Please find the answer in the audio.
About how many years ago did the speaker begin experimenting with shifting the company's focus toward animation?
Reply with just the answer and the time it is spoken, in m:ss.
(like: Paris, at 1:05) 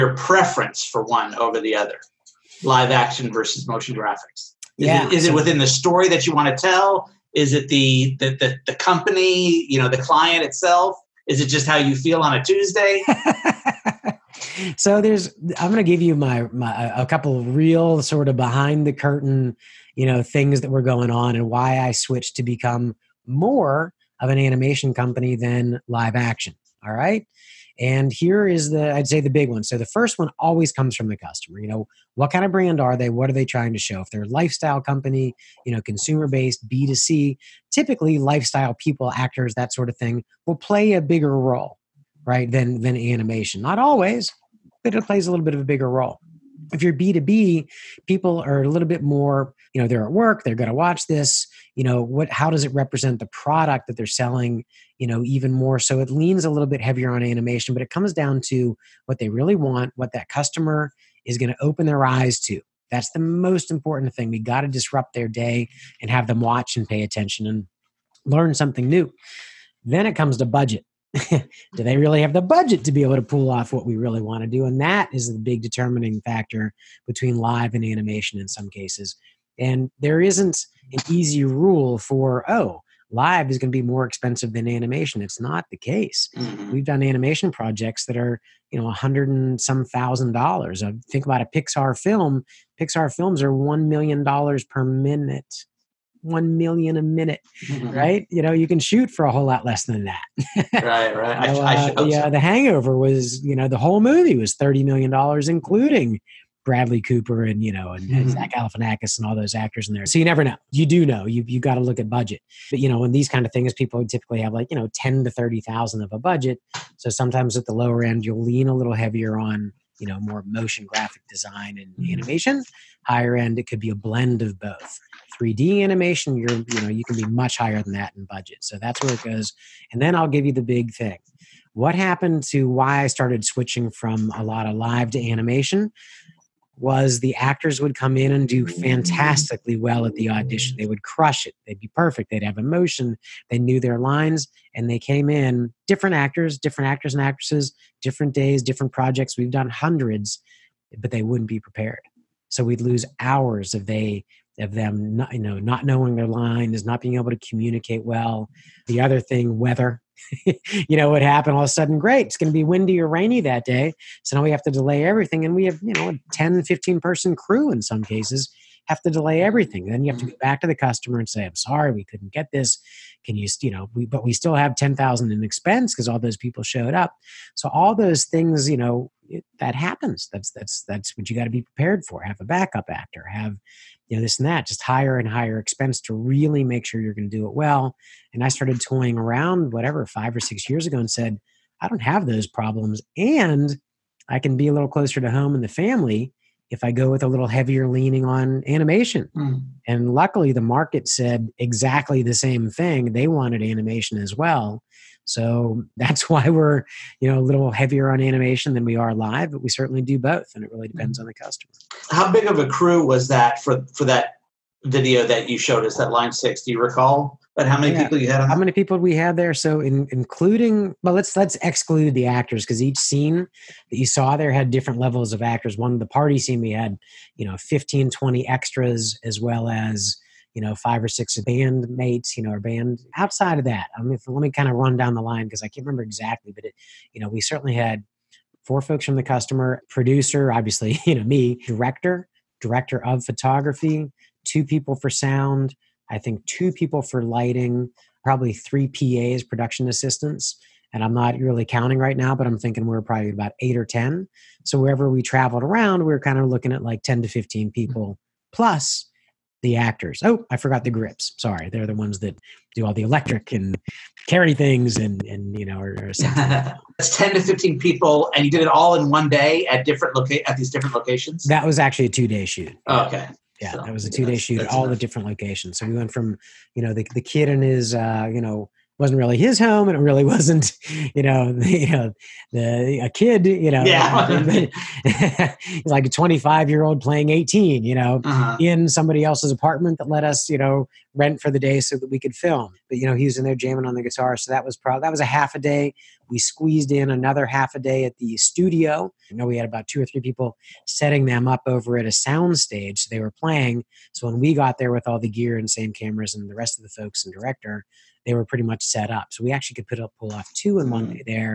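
5 or 6 years, at 3:10.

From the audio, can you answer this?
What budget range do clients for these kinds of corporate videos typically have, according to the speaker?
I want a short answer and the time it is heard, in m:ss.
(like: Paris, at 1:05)
10,000 to 30,000, at 1:54.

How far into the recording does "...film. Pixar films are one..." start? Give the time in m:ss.
1:31.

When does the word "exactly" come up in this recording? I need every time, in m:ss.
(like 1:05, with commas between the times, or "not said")
3:21, 3:56.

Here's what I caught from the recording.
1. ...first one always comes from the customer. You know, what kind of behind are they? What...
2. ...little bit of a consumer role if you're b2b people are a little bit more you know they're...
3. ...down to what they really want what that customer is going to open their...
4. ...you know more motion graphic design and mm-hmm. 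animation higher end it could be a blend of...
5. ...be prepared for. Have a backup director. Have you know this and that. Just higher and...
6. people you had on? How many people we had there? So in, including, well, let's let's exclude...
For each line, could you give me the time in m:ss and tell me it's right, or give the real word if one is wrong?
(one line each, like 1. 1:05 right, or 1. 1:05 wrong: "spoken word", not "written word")
1. 0:29 wrong: "brand", not "behind"
2. 0:45 wrong: "bigger", not "consumer"
3. 0:58 right
4. 1:59 right
5. 3:01 wrong: "actor", not "director"
6. 3:38 right.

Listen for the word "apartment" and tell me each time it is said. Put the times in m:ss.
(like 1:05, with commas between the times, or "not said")
4:49.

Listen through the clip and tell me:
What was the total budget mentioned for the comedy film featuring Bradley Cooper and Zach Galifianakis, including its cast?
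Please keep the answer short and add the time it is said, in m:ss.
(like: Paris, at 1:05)
$30 million, at 1:44.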